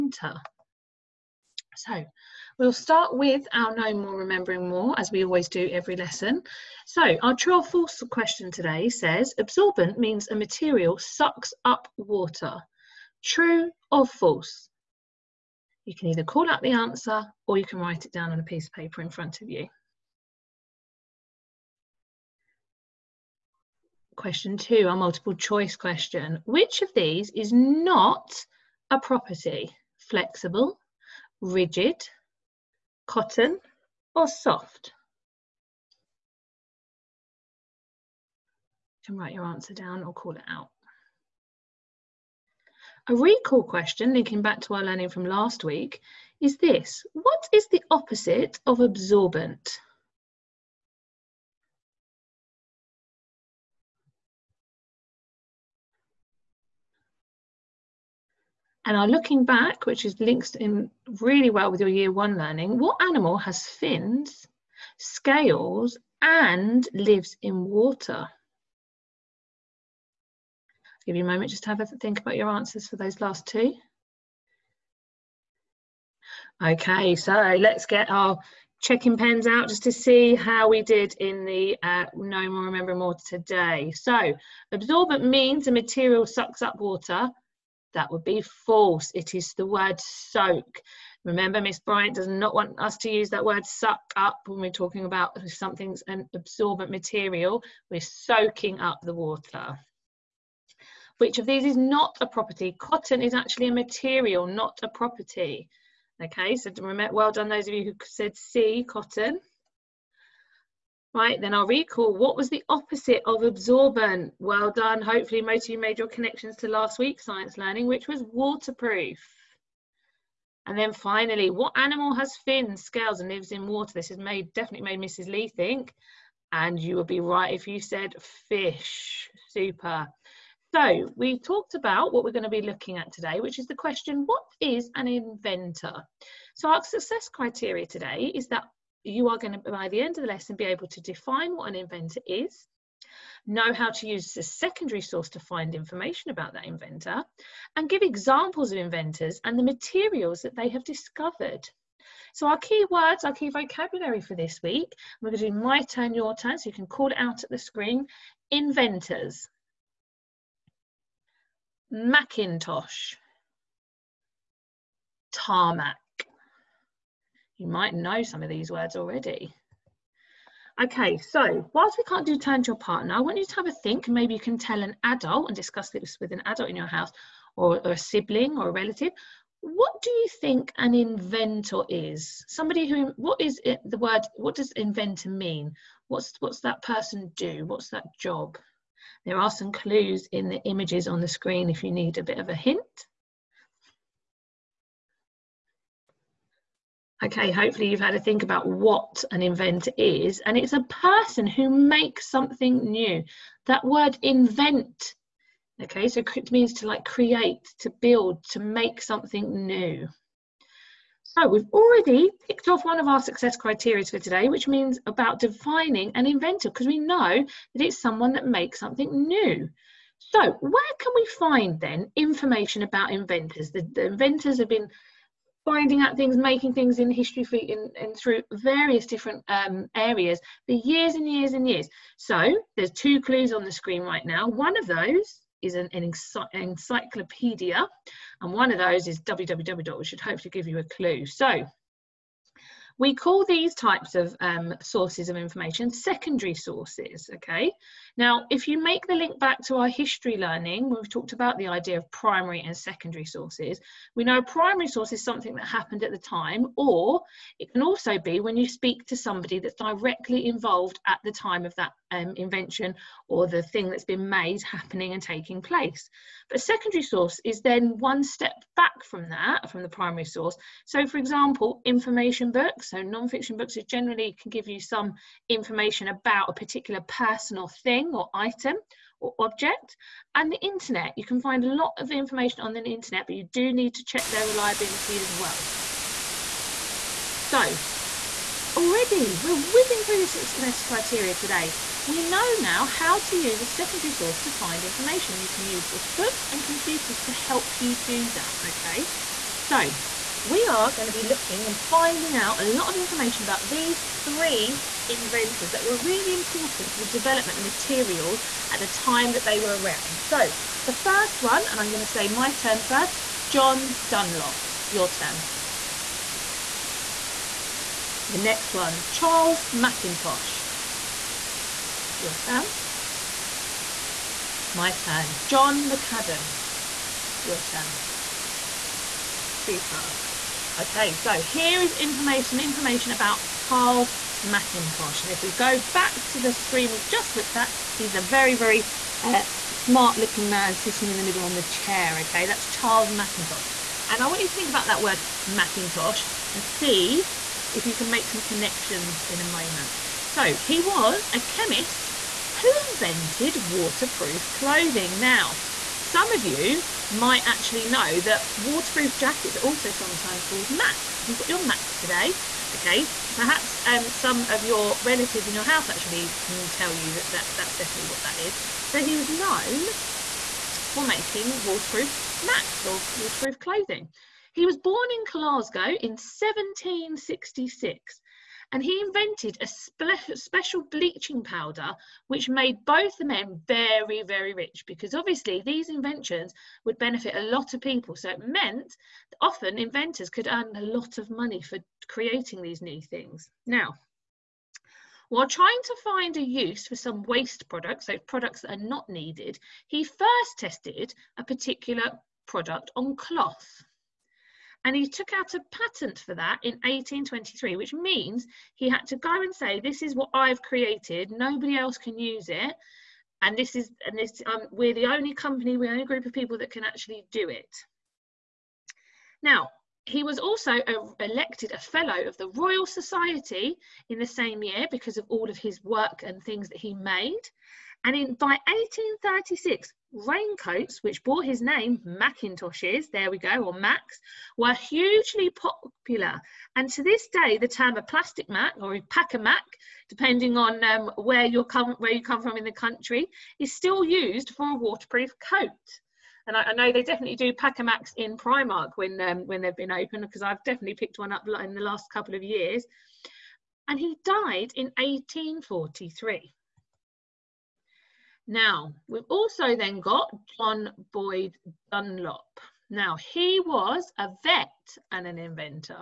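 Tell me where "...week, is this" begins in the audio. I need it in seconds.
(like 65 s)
45 s.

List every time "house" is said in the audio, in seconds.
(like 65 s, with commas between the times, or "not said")
176 s, 365 s.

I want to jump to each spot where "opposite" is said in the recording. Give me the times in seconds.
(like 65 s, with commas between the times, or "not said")
47 s, 112 s.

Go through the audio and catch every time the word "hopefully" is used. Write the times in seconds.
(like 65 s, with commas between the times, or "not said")
115 s, 197 s, 240 s.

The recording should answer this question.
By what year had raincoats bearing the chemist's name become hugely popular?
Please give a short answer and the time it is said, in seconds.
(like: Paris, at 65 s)
1836, at 428 s.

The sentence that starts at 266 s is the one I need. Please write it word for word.
But a secondary source is then one step back from that, from the primary source.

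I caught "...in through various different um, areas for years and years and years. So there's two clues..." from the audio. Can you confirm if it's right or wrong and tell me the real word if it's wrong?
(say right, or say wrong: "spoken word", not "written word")
right.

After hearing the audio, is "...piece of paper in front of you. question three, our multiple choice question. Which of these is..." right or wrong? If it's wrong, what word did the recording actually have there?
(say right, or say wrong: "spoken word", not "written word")
wrong: "two", not "three".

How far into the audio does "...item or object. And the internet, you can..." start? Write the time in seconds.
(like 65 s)
278 s.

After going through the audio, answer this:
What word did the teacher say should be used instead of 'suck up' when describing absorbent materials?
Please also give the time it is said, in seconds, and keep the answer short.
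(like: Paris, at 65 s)
Soak, at 89 s.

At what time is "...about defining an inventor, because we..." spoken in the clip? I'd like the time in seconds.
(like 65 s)
215 s.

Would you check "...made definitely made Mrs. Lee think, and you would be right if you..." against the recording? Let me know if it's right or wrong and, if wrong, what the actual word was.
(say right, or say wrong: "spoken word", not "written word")
right.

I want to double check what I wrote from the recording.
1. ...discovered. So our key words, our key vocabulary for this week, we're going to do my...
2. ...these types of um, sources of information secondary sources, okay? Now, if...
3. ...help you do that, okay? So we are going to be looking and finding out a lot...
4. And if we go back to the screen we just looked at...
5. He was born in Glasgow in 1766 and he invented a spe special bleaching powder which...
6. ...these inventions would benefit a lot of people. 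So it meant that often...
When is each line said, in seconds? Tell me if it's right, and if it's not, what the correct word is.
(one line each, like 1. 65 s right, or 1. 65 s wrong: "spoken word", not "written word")
1. 150 s right
2. 243 s right
3. 297 s right
4. 335 s right
5. 374 s right
6. 385 s right.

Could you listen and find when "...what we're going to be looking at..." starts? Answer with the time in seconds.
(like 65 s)
132 s.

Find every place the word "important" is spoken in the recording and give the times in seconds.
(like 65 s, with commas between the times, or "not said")
306 s.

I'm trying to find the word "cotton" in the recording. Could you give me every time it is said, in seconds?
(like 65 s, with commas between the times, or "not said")
33 s, 102 s, 108 s.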